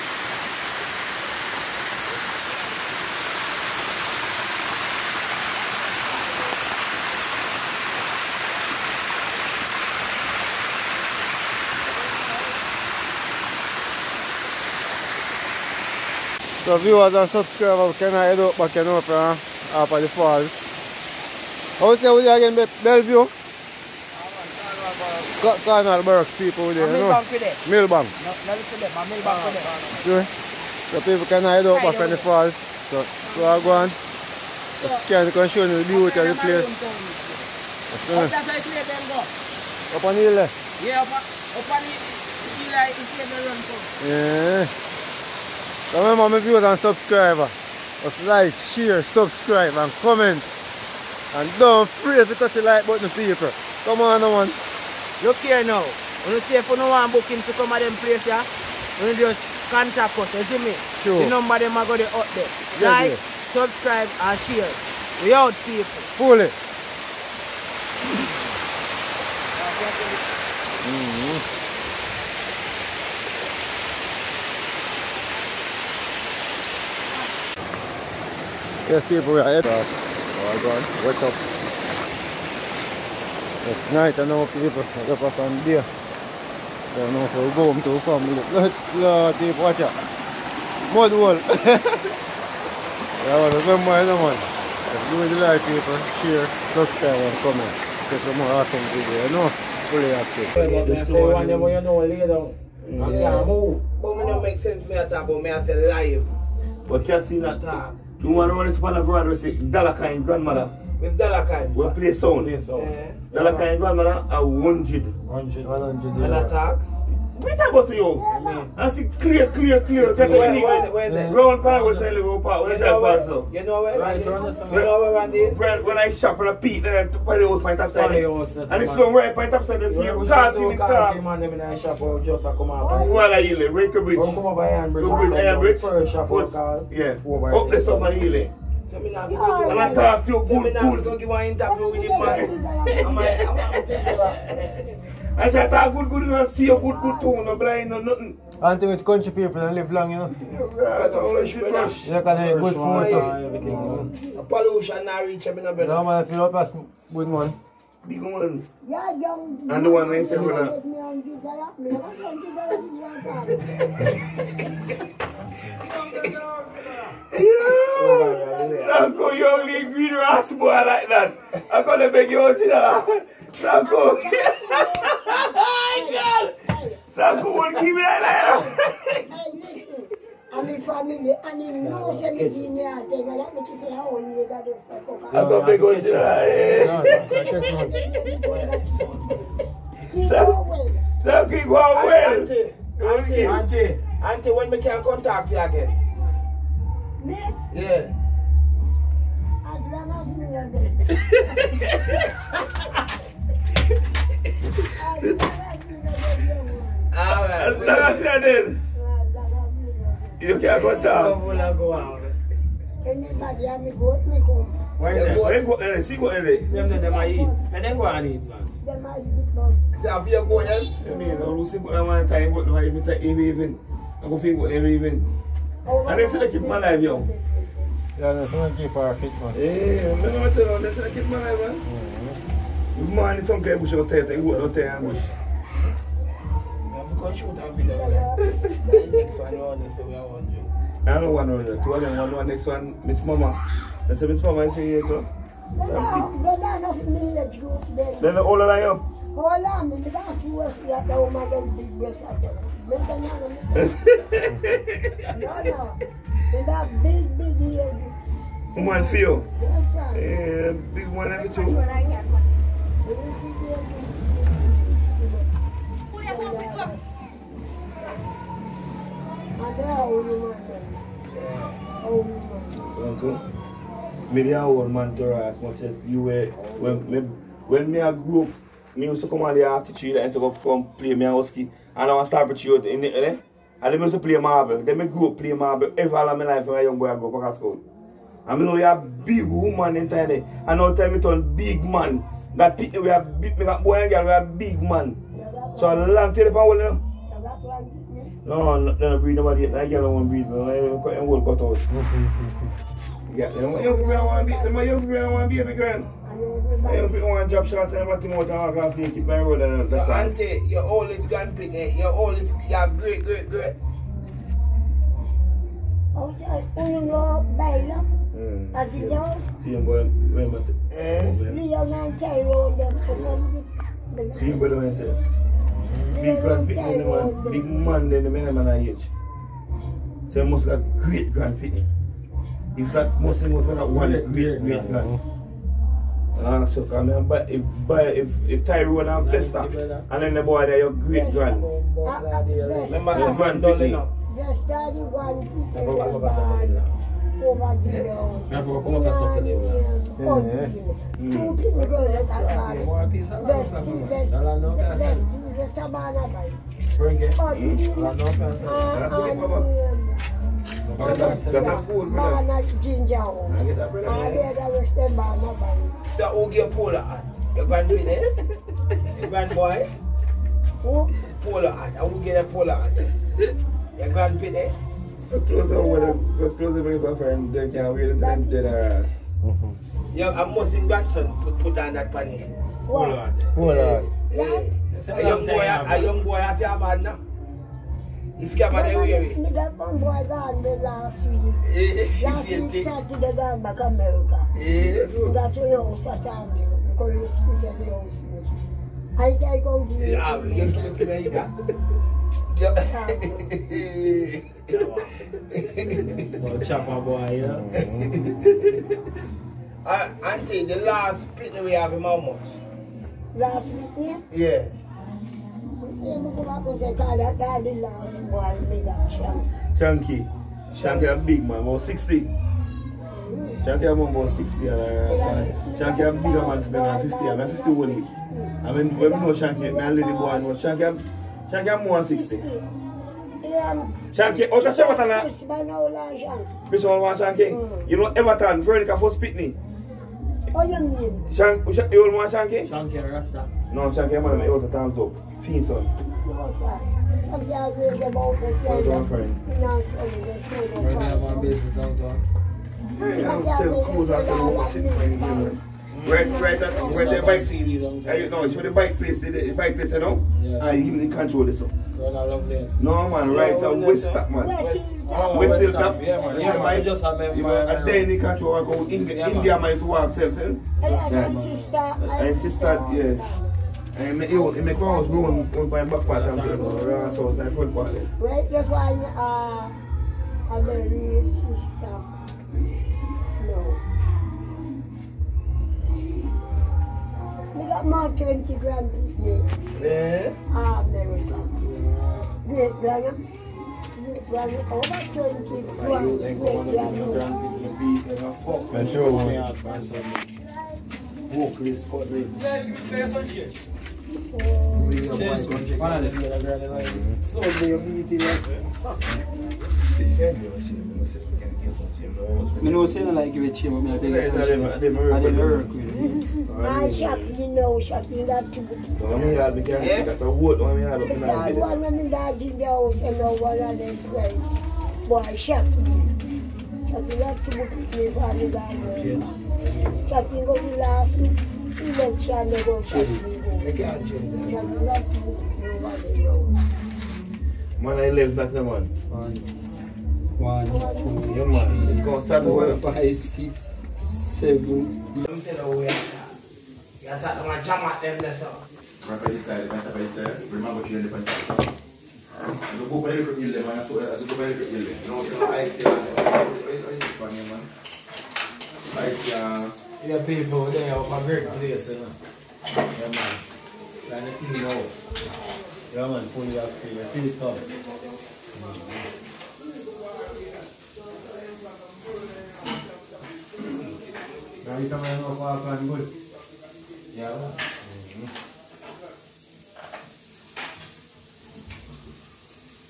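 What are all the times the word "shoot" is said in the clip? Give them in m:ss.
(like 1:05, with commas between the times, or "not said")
3:54.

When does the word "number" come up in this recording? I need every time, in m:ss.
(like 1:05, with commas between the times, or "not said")
1:01.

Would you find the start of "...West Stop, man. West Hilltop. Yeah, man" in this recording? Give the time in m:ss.
7:43.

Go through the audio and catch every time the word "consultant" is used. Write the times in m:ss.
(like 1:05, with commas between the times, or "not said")
not said.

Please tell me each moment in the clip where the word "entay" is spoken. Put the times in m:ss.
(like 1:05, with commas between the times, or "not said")
4:49.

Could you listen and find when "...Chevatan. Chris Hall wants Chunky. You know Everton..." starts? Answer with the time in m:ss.
7:14.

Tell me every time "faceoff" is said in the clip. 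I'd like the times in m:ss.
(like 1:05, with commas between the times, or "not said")
not said.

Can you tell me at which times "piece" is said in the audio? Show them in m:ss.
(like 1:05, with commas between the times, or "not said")
5:45, 5:53.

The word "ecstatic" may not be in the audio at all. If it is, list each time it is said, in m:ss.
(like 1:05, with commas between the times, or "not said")
not said.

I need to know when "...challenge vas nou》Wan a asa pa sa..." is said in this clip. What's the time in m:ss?
2:01.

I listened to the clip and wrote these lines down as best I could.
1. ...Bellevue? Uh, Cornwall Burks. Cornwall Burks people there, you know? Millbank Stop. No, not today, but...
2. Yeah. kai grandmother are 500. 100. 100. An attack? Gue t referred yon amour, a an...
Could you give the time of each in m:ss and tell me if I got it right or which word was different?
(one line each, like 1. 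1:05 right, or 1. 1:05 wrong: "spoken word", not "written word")
1. 0:22 wrong: "Millbank", not "Stop"
2. 1:53 wrong: "100", not "500".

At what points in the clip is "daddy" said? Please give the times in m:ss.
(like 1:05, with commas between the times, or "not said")
5:44.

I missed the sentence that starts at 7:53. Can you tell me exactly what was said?
And it, it, it make grow when, back part So it's part.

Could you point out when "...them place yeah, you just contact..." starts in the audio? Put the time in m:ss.
0:57.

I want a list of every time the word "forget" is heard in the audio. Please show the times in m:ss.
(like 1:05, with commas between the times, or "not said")
0:51.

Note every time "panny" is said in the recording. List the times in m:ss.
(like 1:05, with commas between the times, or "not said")
6:22.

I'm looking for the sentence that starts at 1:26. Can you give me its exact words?
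Don't know if we're going to family.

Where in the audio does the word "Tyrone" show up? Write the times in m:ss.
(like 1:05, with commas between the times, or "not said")
5:38.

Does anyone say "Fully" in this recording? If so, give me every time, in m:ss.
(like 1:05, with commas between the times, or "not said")
1:06, 1:39.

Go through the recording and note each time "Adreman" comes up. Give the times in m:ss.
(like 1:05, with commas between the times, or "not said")
3:19, 3:27.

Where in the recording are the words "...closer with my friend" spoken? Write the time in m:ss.
6:16.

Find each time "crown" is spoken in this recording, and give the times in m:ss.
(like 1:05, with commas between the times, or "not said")
2:15.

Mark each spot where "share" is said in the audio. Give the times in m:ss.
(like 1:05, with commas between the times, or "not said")
0:48, 1:04, 1:36.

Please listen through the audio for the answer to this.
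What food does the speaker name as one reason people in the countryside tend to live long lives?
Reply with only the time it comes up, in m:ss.
2:31.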